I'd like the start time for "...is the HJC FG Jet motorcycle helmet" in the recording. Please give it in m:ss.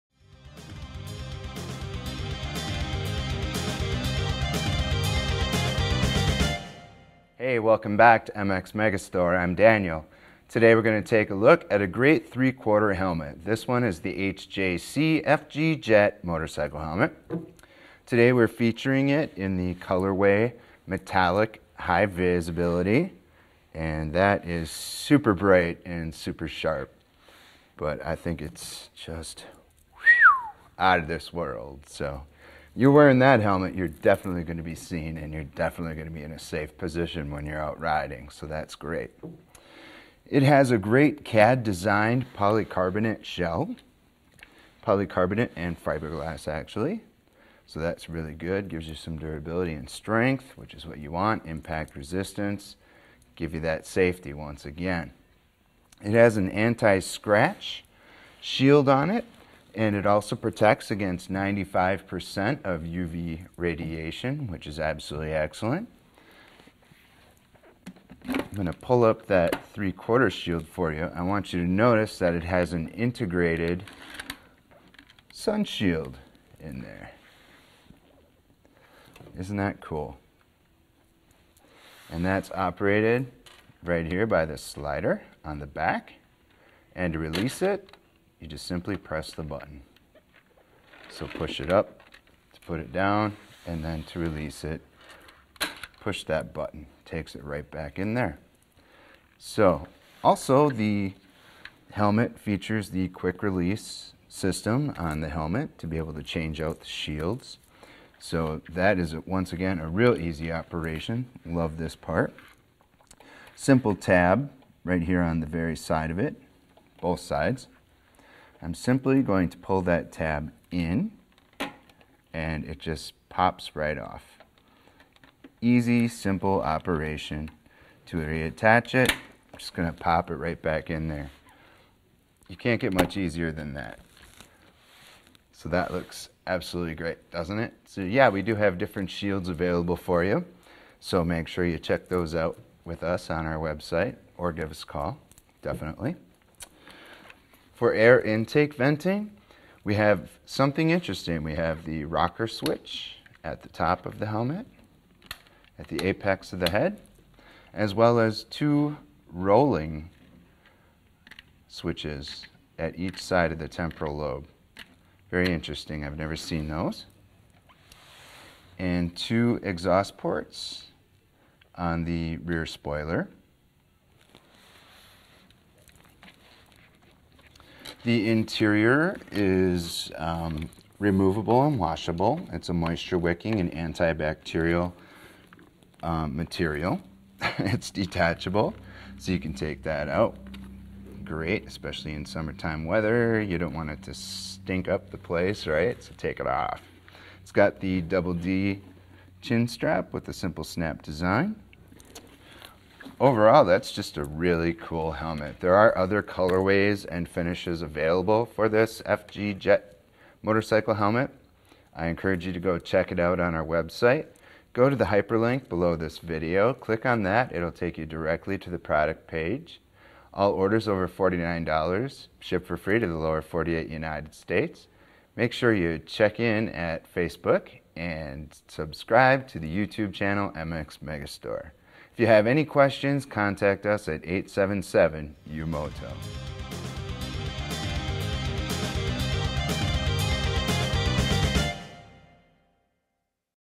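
0:13.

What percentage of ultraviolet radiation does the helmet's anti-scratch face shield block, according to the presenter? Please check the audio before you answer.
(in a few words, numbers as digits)
95%.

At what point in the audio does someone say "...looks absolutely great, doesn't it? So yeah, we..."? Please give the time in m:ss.
2:15.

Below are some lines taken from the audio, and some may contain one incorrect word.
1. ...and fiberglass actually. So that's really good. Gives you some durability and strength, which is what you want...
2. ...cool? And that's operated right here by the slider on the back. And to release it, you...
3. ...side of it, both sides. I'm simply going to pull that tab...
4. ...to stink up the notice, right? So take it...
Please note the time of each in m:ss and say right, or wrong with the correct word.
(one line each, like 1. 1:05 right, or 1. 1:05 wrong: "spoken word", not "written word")
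1. 0:45 right
2. 1:19 right
3. 1:55 right
4. 3:14 wrong: "place", not "notice".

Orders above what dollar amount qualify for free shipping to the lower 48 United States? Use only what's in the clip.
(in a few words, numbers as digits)
$49.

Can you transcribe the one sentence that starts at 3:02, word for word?
It's a moisture wicking and antibacterial um, material.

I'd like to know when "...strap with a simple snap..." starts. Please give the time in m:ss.
3:19.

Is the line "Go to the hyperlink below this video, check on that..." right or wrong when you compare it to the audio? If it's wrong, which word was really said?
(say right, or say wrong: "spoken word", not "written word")
wrong: "click", not "check".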